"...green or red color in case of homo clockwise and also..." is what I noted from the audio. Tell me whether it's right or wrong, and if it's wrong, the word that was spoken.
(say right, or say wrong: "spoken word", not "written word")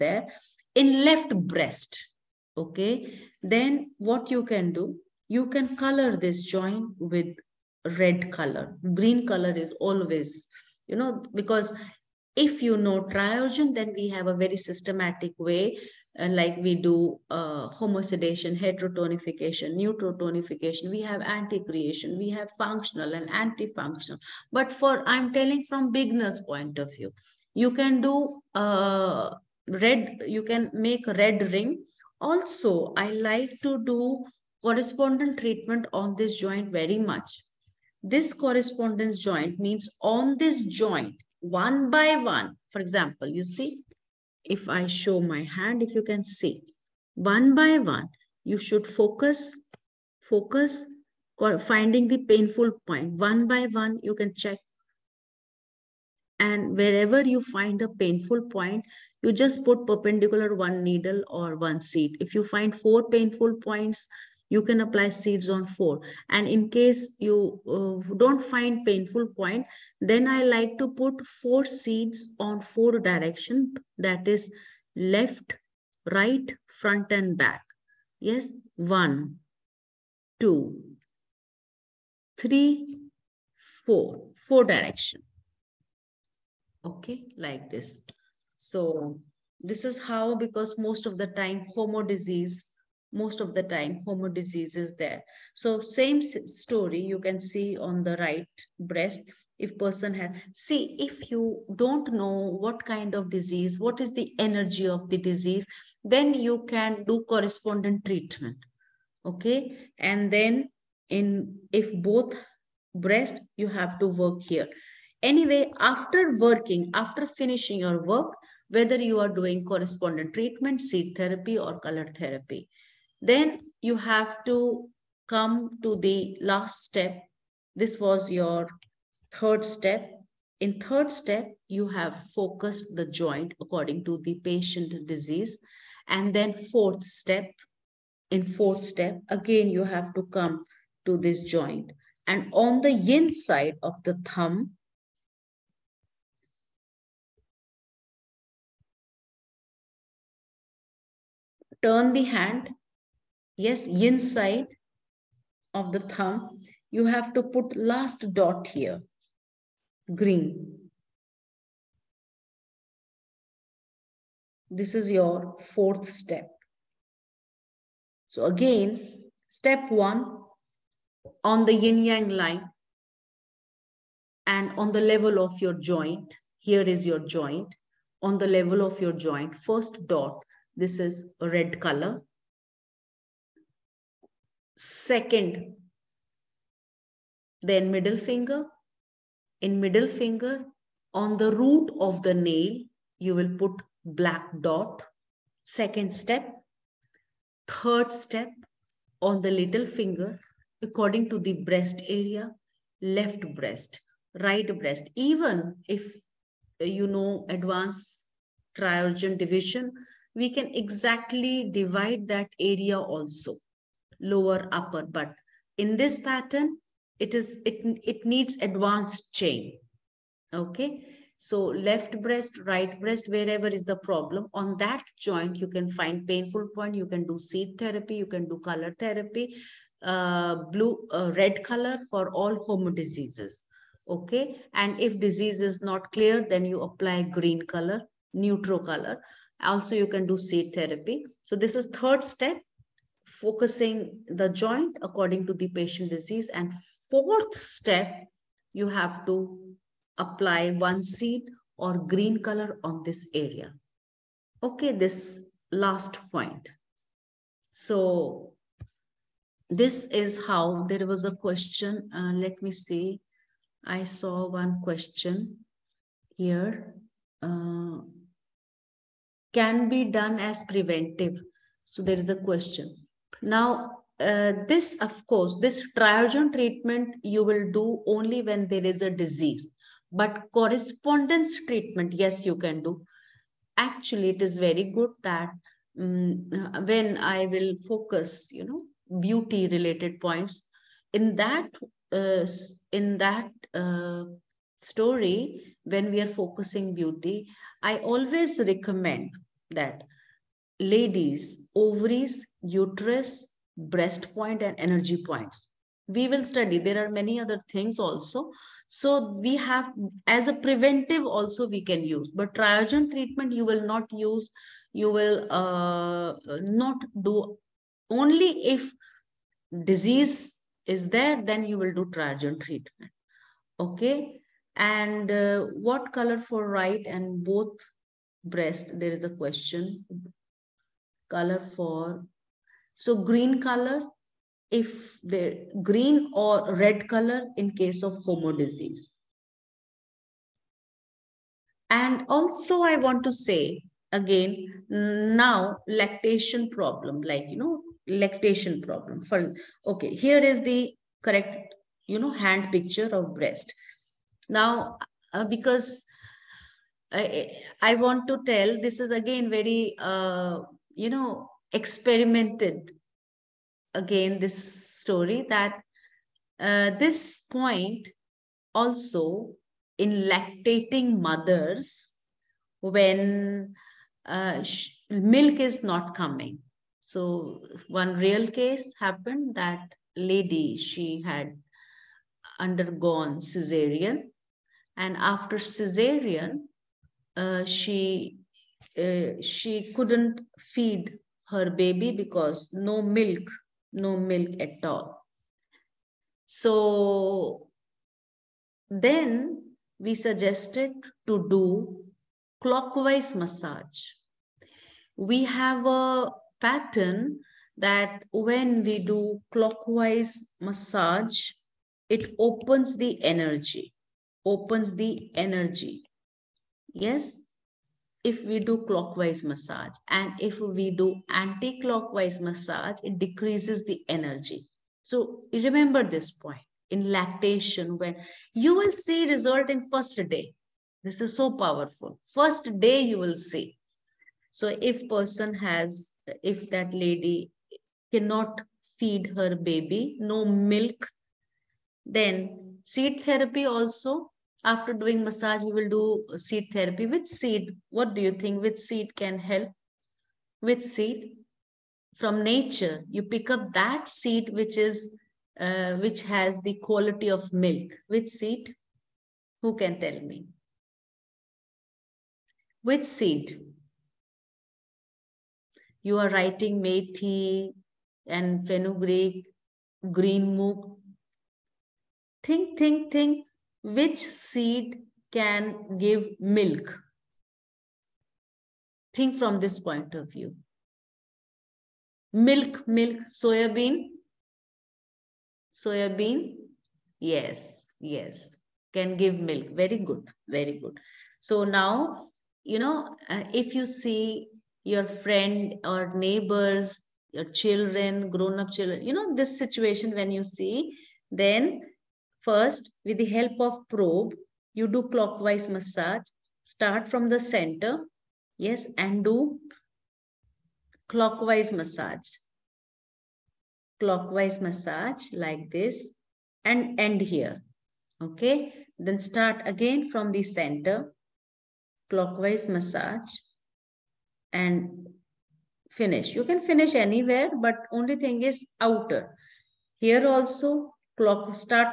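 wrong: "disease", not "clockwise".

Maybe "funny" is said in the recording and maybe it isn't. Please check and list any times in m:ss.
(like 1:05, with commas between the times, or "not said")
not said.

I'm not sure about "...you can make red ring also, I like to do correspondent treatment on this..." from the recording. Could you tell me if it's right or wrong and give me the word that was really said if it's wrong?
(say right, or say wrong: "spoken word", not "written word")
right.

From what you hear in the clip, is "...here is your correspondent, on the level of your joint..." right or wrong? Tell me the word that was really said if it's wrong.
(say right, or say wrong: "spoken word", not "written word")
wrong: "joint", not "correspondent".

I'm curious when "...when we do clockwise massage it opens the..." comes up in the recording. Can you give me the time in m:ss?
6:48.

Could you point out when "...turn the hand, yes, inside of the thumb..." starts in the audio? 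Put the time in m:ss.
2:31.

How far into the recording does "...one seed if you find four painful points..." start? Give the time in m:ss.
1:01.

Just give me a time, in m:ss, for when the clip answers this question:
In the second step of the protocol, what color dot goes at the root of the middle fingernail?
3:14.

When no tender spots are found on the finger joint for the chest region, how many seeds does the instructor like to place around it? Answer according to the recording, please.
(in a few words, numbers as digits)
4.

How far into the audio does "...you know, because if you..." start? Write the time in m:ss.
0:10.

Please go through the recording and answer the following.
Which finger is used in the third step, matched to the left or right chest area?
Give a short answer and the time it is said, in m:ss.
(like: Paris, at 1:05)
Little finger, at 3:19.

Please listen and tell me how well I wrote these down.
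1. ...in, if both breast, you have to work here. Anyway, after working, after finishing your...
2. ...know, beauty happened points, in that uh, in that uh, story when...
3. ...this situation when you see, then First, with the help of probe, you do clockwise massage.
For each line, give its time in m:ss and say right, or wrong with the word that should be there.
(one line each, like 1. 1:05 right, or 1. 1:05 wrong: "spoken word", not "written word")
1. 1:51 right
2. 4:48 wrong: "related", not "happened"
3. 8:19 right.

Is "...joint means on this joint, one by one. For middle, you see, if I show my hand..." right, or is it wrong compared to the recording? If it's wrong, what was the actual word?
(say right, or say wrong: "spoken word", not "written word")
wrong: "example", not "middle".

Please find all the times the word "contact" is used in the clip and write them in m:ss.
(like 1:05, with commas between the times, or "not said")
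not said.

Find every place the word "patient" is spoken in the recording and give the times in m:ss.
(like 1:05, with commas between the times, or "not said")
2:14, 4:05.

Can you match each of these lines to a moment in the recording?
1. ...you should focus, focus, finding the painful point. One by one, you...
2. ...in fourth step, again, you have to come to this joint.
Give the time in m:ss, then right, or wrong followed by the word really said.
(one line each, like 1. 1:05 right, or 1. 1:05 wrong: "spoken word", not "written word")
1. 0:48 right
2. 2:18 right.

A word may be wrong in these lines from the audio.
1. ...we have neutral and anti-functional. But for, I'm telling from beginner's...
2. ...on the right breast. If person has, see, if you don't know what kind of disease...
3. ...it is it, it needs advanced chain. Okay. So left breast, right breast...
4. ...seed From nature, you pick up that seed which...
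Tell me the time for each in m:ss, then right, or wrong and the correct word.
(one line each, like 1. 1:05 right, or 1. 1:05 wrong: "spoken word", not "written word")
1. 0:22 wrong: "functional", not "neutral"
2. 1:37 right
3. 3:37 right
4. 7:30 right.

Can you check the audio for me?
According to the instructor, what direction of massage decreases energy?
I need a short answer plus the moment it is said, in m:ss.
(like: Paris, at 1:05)
Anti-clockwise, at 7:01.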